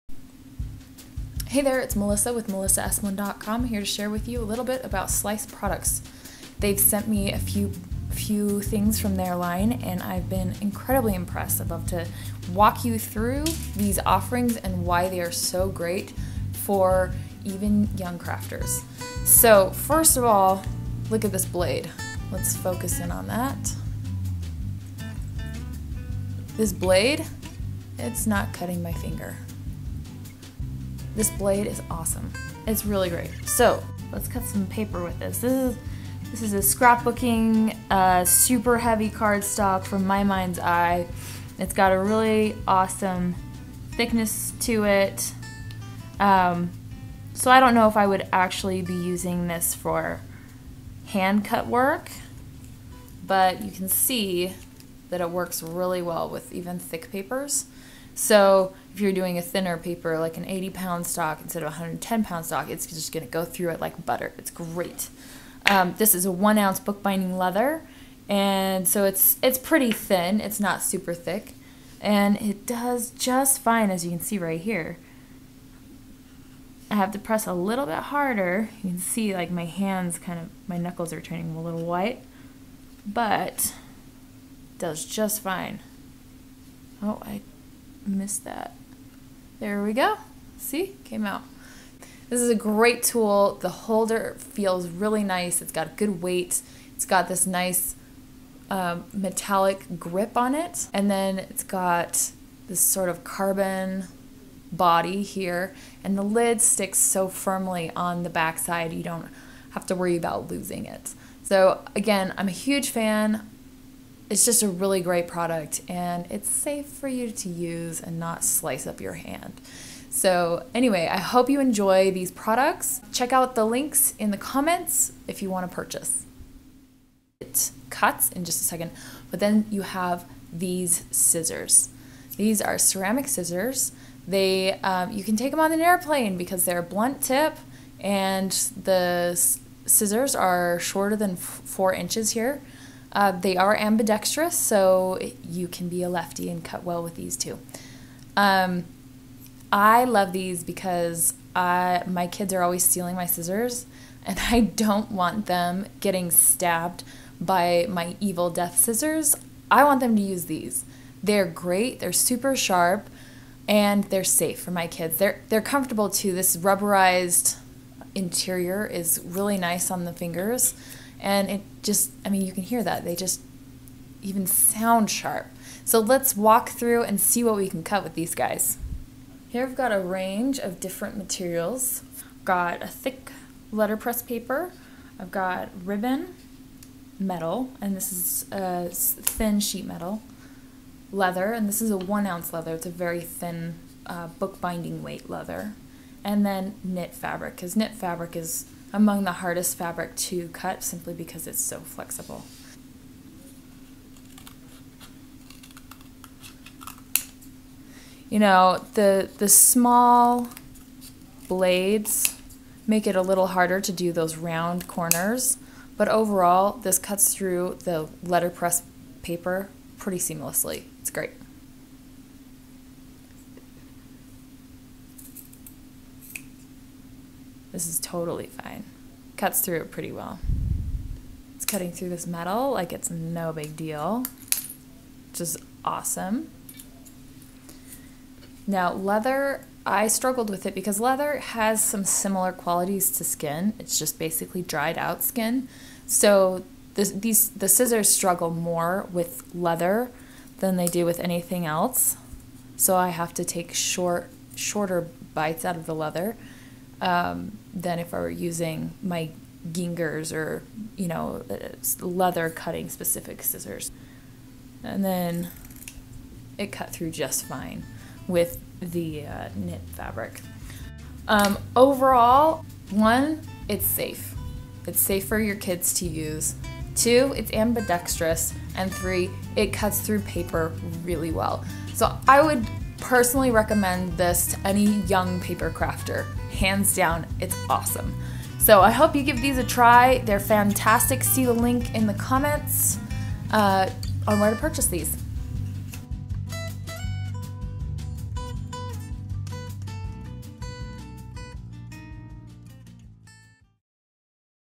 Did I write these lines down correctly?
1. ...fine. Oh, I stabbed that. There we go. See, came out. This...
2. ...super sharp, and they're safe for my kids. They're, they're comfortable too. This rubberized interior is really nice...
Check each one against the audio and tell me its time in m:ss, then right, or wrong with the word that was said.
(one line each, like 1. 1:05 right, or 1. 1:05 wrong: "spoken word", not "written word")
1. 1:25 wrong: "missed", not "stabbed"
2. 2:42 right.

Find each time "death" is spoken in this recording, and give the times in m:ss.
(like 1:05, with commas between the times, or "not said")
2:38.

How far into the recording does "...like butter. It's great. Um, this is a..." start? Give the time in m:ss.
1:03.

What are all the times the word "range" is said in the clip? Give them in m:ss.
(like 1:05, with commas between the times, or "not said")
2:59.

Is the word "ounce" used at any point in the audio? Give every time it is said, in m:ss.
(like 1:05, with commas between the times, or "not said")
1:06, 3:12.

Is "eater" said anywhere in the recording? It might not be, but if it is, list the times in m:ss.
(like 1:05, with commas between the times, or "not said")
not said.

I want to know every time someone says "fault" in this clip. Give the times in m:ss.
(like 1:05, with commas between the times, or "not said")
not said.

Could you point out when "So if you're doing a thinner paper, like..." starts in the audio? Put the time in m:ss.
0:58.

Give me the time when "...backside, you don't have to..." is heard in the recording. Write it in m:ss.
1:48.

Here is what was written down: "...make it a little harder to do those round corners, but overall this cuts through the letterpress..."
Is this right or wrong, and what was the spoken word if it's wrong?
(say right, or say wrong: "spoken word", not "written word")
right.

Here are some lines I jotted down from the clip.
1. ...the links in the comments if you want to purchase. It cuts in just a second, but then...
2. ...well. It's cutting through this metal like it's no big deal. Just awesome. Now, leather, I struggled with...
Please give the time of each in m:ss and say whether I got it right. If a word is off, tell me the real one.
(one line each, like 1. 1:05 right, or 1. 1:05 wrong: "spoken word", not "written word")
1. 2:03 right
2. 3:50 right.